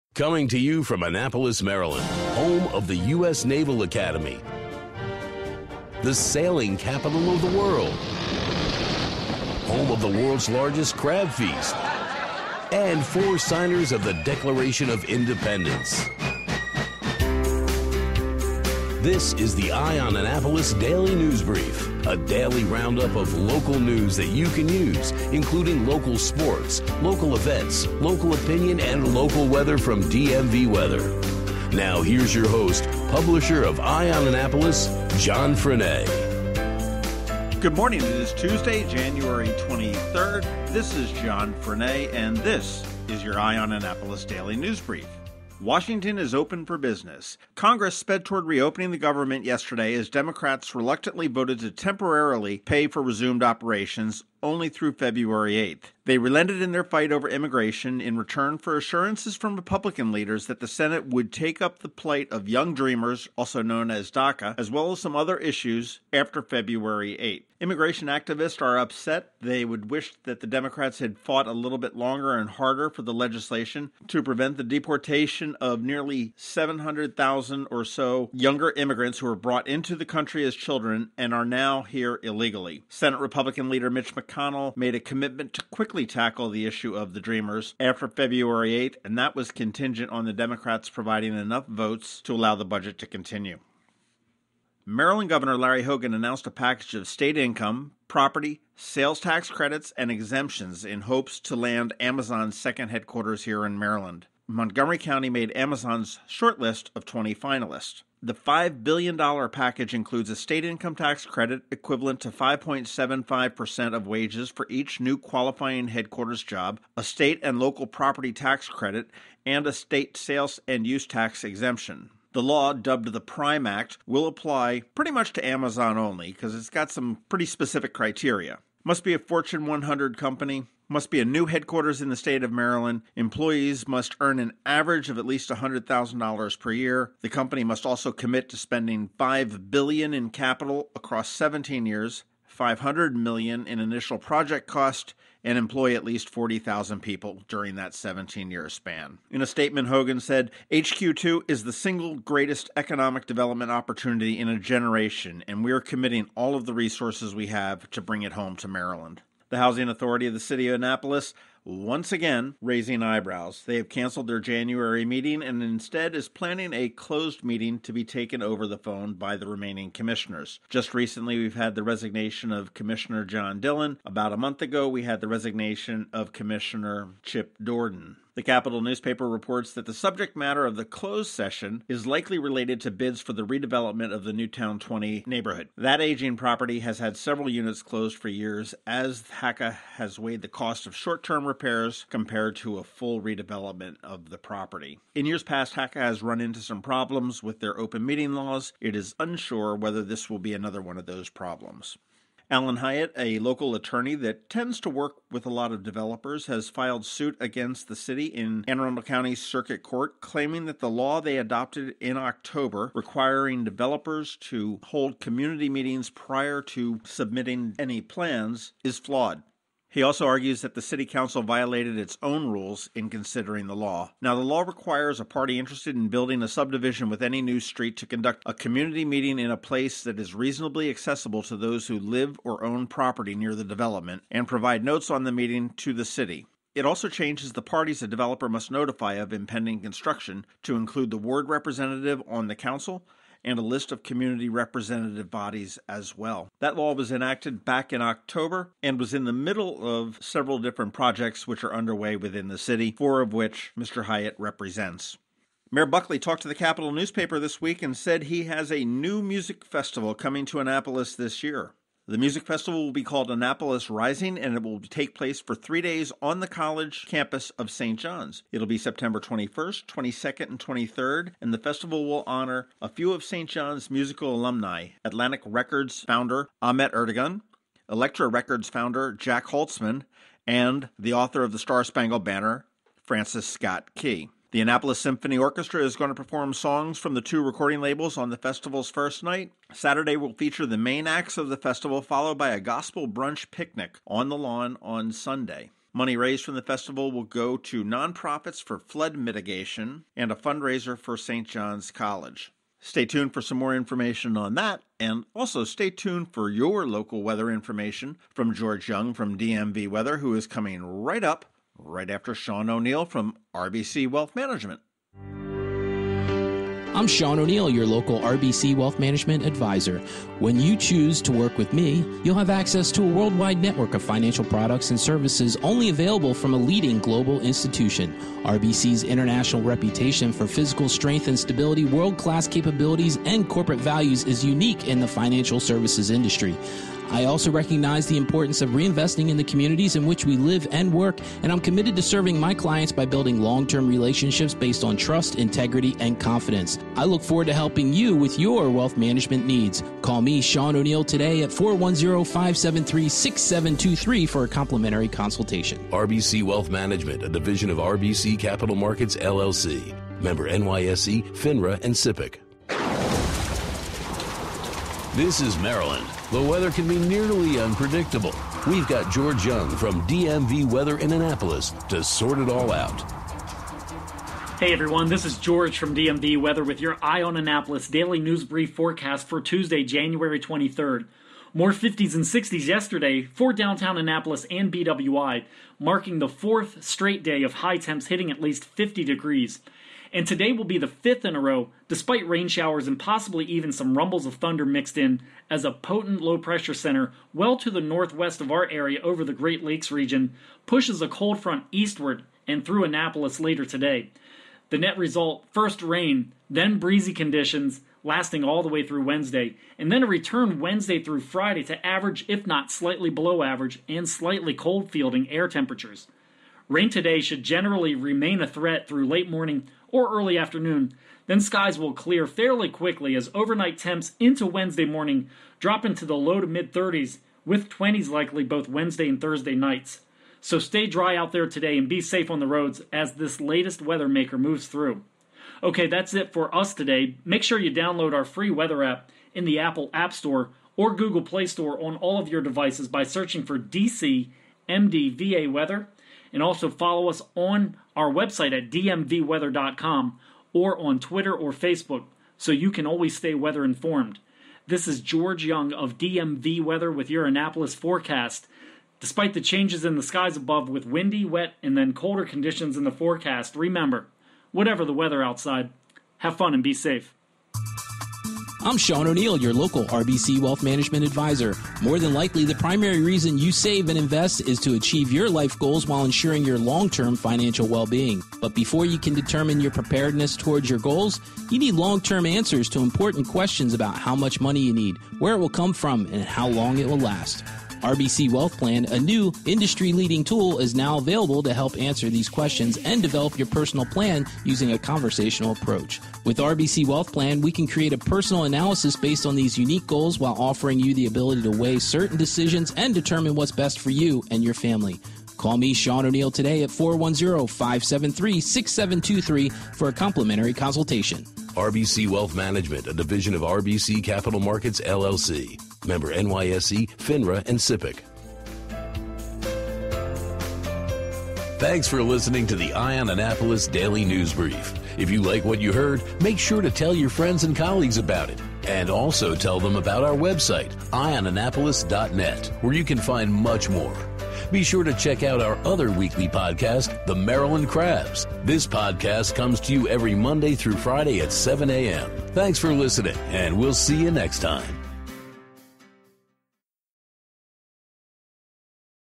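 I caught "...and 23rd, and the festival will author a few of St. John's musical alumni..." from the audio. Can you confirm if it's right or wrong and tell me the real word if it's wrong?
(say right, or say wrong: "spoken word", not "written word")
wrong: "honor", not "author".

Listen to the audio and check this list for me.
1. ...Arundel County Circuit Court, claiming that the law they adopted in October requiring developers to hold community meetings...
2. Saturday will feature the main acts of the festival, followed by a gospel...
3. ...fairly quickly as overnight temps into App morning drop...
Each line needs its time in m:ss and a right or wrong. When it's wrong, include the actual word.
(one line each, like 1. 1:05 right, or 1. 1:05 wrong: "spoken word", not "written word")
1. 3:28 right
2. 4:49 right
3. 7:02 wrong: "Wednesday", not "App".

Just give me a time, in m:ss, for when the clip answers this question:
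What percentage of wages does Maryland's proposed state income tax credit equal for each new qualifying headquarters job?
1:52.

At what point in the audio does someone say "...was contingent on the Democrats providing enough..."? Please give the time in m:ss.
1:29.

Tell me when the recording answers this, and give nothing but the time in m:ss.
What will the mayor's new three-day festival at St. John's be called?
4:23.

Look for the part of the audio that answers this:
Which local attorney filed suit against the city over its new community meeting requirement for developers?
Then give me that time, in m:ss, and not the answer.
3:22.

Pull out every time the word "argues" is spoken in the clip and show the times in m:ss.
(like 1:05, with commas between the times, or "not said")
3:40.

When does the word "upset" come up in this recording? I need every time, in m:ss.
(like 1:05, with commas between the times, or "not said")
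1:08.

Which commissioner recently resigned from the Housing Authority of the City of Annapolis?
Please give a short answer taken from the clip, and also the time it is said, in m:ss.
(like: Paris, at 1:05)
John Dillon, at 2:53.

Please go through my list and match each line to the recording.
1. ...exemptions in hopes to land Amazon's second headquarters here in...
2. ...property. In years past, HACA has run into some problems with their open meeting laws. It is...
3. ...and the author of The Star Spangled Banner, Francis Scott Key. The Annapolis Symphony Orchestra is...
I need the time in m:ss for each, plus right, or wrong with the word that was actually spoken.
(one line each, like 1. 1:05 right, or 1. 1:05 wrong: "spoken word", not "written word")
1. 1:40 right
2. 3:14 right
3. 4:40 right.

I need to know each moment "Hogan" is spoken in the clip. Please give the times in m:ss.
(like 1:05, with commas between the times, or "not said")
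1:35, 2:29.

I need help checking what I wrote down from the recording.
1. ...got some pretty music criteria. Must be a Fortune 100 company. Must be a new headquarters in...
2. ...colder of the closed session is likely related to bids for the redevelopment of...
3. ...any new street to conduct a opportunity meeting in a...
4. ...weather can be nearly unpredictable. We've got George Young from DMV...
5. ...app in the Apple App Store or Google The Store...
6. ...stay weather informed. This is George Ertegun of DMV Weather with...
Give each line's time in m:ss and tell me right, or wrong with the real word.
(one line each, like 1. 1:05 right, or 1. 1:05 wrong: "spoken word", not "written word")
1. 2:06 wrong: "specific", not "music"
2. 3:00 wrong: "matter", not "colder"
3. 3:47 wrong: "community", not "opportunity"
4. 6:06 right
5. 7:18 wrong: "Play", not "The"
6. 7:33 wrong: "Young", not "Ertegun".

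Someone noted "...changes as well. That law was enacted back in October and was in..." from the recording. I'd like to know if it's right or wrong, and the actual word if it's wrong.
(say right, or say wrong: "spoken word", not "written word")
wrong: "bodies", not "changes".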